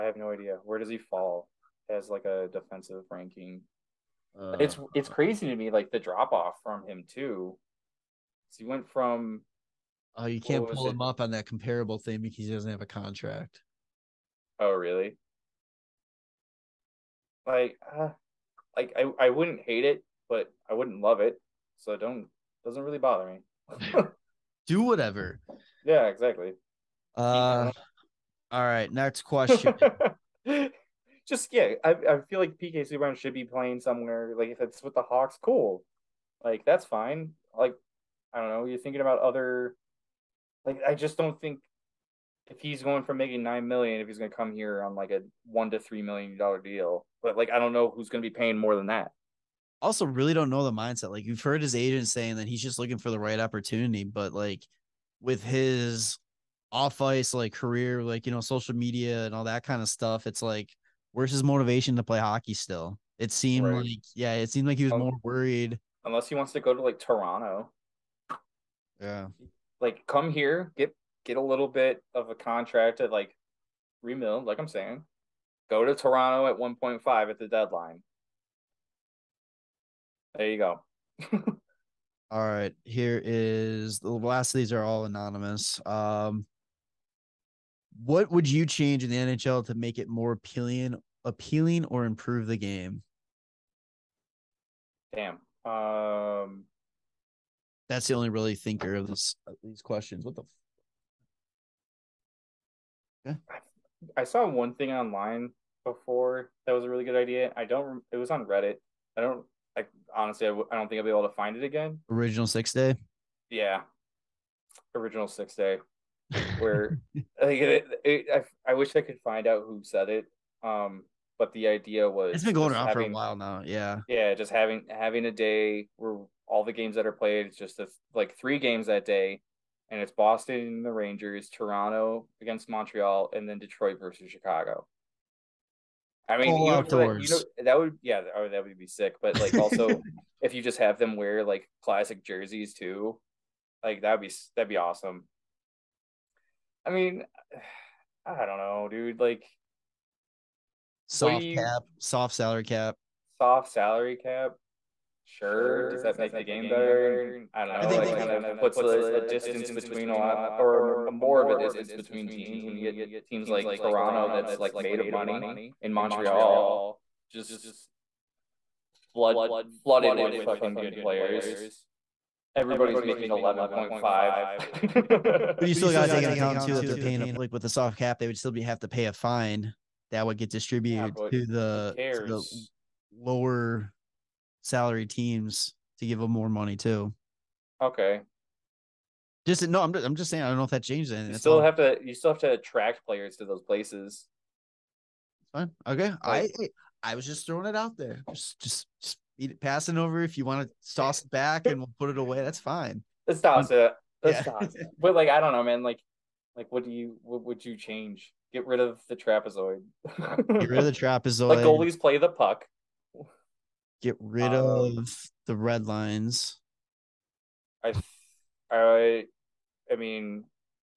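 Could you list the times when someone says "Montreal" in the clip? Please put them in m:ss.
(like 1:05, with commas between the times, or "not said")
2:12, 2:45.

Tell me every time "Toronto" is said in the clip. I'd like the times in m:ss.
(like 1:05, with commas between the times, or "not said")
1:06, 1:15, 2:11, 2:43.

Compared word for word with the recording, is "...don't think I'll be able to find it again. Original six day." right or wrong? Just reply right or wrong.
right.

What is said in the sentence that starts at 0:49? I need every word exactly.
Also, really don't know the mindset.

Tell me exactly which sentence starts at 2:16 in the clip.
I mean, you know, that, you know, that would yeah, that would be sick.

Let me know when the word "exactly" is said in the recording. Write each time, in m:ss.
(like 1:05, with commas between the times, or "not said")
0:26.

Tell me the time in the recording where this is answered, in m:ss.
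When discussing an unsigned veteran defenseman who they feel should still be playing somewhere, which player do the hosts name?
0:32.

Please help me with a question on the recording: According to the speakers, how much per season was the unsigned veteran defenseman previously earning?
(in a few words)
9 million.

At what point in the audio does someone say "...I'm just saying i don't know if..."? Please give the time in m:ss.
3:10.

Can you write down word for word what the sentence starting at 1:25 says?
Um what would you change in the NHL to make it more appealing, appealing or improve the game?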